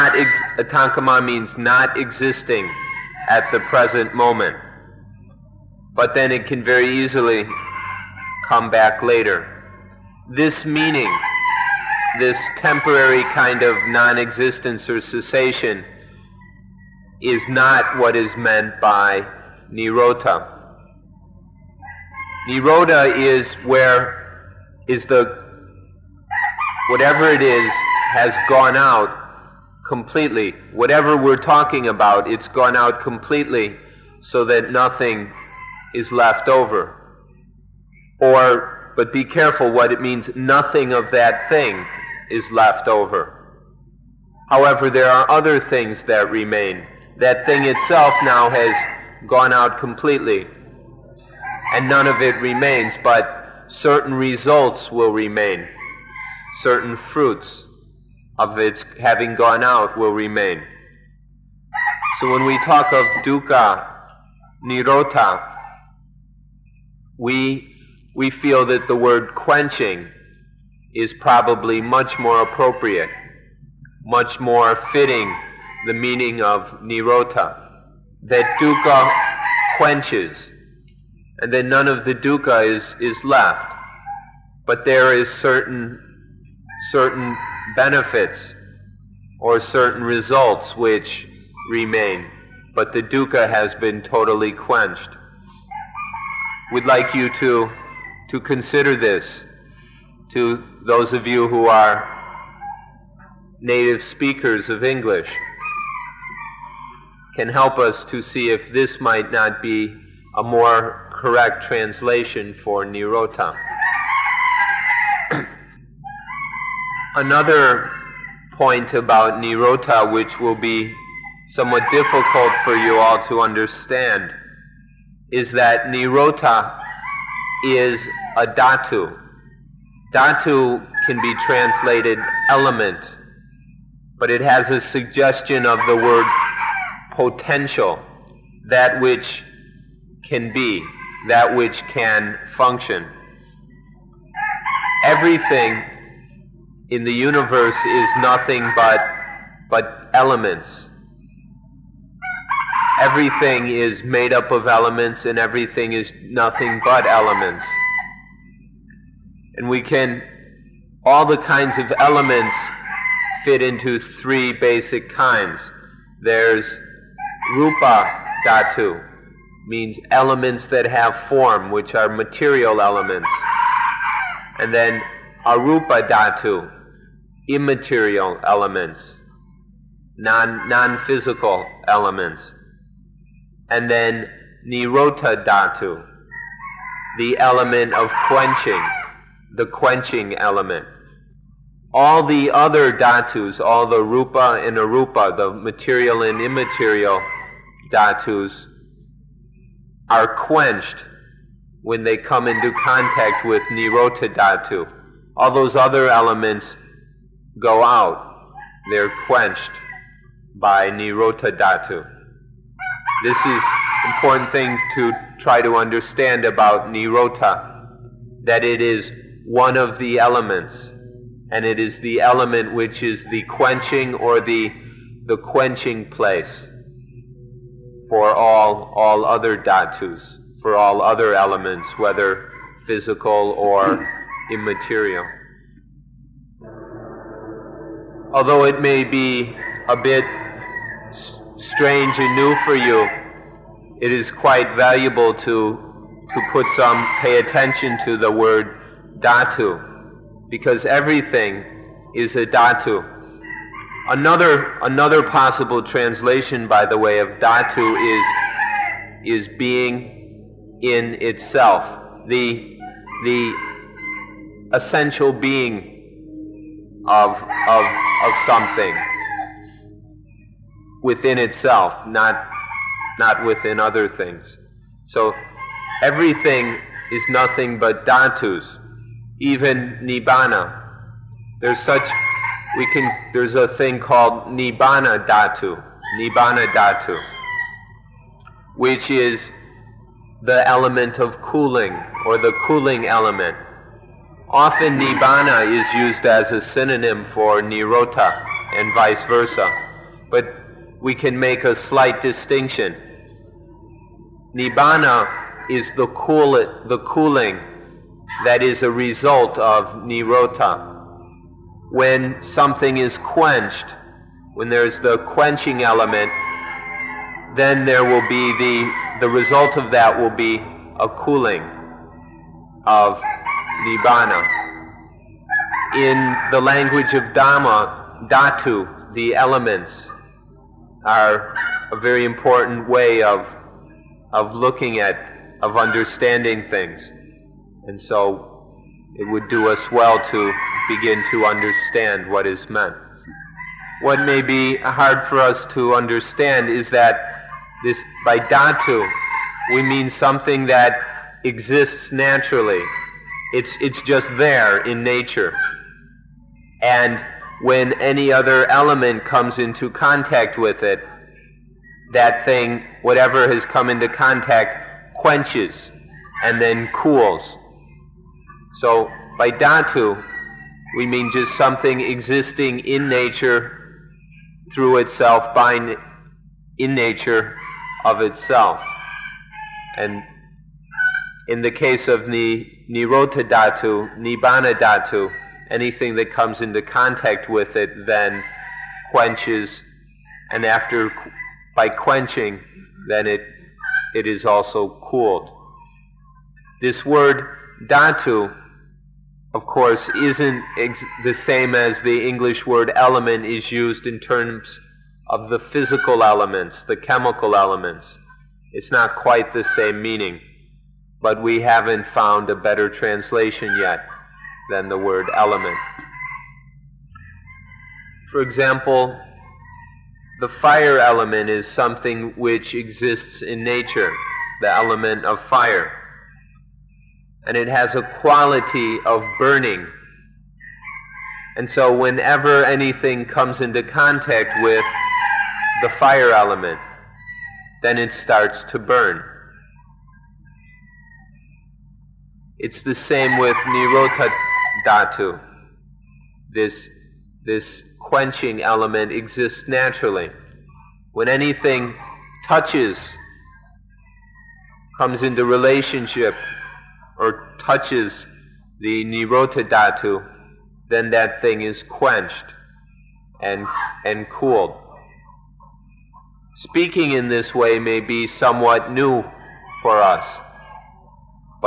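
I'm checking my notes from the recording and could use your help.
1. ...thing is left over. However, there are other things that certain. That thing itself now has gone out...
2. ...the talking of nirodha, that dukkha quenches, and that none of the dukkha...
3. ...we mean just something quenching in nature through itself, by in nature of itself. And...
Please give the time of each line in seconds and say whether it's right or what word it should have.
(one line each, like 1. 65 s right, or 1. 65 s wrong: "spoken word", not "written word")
1. 41 s wrong: "remain", not "certain"
2. 75 s wrong: "meaning", not "talking"
3. 370 s wrong: "existing", not "quenching".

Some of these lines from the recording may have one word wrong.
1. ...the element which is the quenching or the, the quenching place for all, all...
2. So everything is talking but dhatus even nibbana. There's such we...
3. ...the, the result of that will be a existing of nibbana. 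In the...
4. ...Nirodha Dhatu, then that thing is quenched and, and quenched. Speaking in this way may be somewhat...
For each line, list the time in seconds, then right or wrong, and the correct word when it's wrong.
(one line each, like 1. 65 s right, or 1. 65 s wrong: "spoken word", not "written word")
1. 221 s right
2. 275 s wrong: "nothing", not "talking"
3. 318 s wrong: "cooling", not "existing"
4. 459 s wrong: "cooled", not "quenched".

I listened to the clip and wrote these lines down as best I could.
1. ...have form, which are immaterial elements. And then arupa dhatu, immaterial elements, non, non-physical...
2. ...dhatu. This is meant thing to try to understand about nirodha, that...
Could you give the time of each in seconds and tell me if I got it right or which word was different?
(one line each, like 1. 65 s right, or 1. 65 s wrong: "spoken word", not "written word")
1. 170 s wrong: "material", not "immaterial"
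2. 211 s wrong: "important", not "meant".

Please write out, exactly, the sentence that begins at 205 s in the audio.
All those other elements go out.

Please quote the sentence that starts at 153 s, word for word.
Everything is made up of elements and everything is nothing but elements.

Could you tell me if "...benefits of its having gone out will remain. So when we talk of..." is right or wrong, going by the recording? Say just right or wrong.
wrong.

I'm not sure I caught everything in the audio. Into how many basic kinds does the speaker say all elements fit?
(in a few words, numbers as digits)
3.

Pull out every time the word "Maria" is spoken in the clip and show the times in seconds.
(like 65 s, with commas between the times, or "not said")
not said.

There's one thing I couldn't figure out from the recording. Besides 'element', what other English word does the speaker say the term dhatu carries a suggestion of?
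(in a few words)
potential.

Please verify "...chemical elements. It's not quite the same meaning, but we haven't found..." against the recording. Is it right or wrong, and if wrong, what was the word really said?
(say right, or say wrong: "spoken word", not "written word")
right.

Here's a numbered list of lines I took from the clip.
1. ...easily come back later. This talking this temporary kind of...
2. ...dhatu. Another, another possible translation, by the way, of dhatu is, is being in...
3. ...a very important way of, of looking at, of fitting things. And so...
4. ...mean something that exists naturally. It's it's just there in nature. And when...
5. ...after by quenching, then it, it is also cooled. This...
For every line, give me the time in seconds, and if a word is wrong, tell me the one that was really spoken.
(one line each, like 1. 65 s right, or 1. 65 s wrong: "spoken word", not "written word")
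1. 6 s wrong: "meaning", not "talking"
2. 252 s right
3. 331 s wrong: "understanding", not "fitting"
4. 349 s right
5. 390 s right.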